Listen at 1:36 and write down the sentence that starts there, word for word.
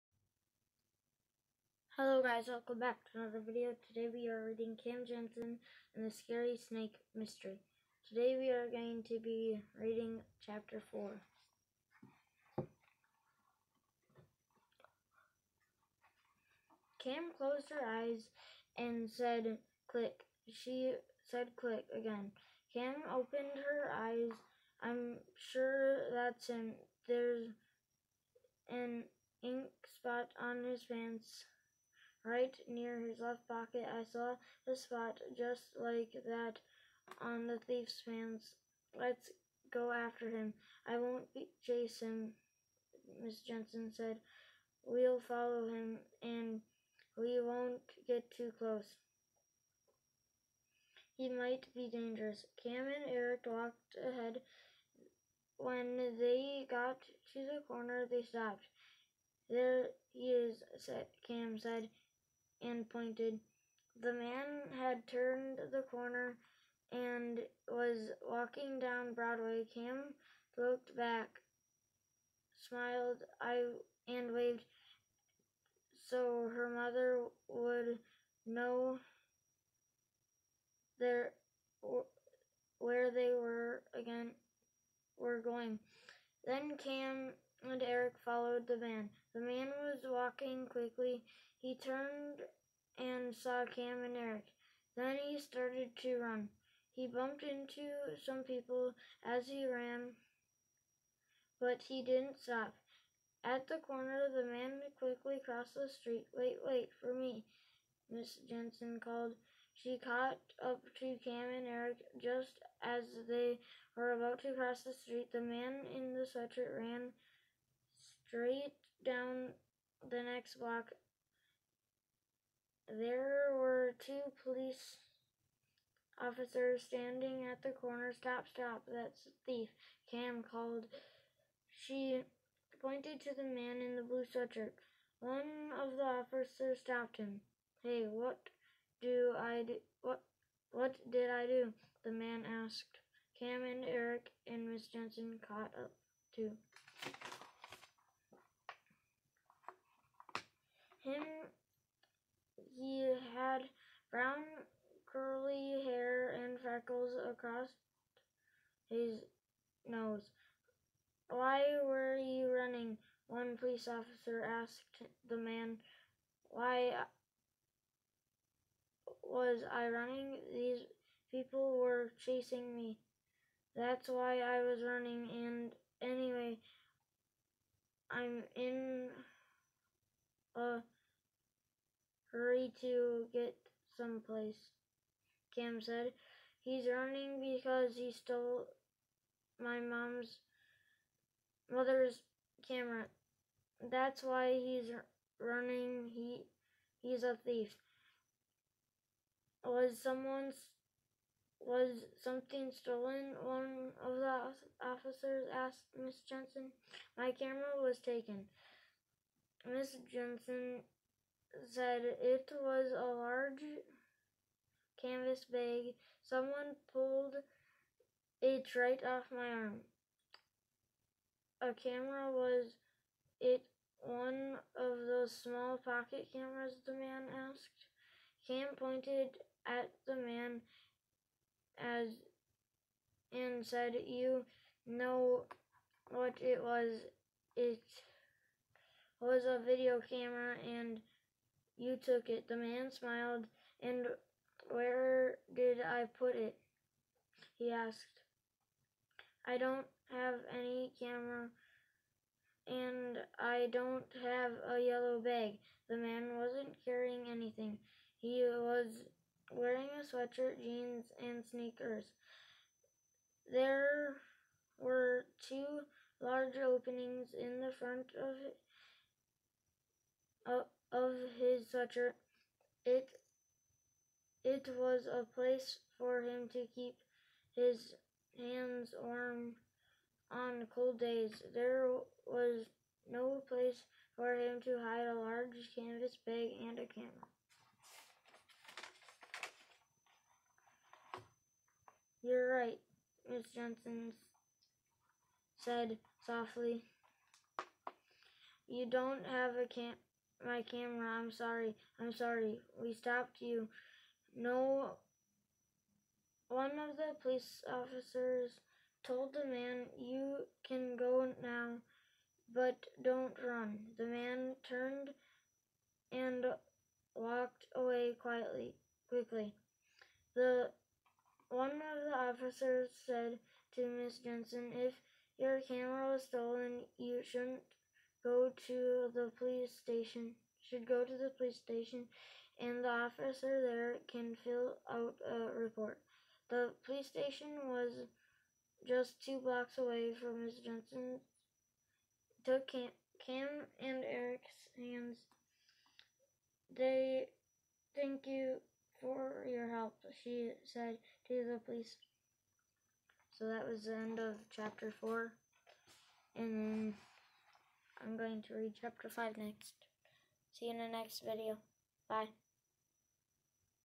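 He bumped into some people as he ran, but he didn't stop.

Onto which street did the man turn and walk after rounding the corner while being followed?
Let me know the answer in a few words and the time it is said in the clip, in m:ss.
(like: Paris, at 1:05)
Broadway, at 1:09.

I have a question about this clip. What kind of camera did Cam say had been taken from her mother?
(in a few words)
A video camera.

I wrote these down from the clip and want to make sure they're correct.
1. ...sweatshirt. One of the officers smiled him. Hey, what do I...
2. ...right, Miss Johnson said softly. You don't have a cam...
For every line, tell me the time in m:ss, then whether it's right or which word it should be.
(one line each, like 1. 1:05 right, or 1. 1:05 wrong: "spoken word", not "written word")
1. 2:14 wrong: "stopped", not "smiled"
2. 4:52 right.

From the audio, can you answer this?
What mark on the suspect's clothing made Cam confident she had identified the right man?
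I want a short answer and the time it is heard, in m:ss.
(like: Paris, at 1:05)
An ink spot, at 0:28.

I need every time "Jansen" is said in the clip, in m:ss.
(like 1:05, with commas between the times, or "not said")
0:05, 0:43, 1:48, 2:24, 5:24, 5:40.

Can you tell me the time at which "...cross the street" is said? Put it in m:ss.
1:54.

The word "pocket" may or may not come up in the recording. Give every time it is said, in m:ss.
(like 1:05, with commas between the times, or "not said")
0:33, 3:45.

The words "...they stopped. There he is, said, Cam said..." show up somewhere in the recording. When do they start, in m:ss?
0:58.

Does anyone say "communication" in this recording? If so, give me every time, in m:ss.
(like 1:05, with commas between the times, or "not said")
not said.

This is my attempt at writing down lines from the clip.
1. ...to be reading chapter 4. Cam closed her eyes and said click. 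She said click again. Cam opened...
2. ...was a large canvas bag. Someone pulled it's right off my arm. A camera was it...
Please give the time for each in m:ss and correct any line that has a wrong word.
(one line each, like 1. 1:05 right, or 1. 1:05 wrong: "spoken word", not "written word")
1. 0:09 right
2. 3:32 right.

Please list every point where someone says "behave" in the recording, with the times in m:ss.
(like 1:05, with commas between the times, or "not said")
not said.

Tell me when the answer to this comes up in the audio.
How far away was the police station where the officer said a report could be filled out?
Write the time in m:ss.
5:39.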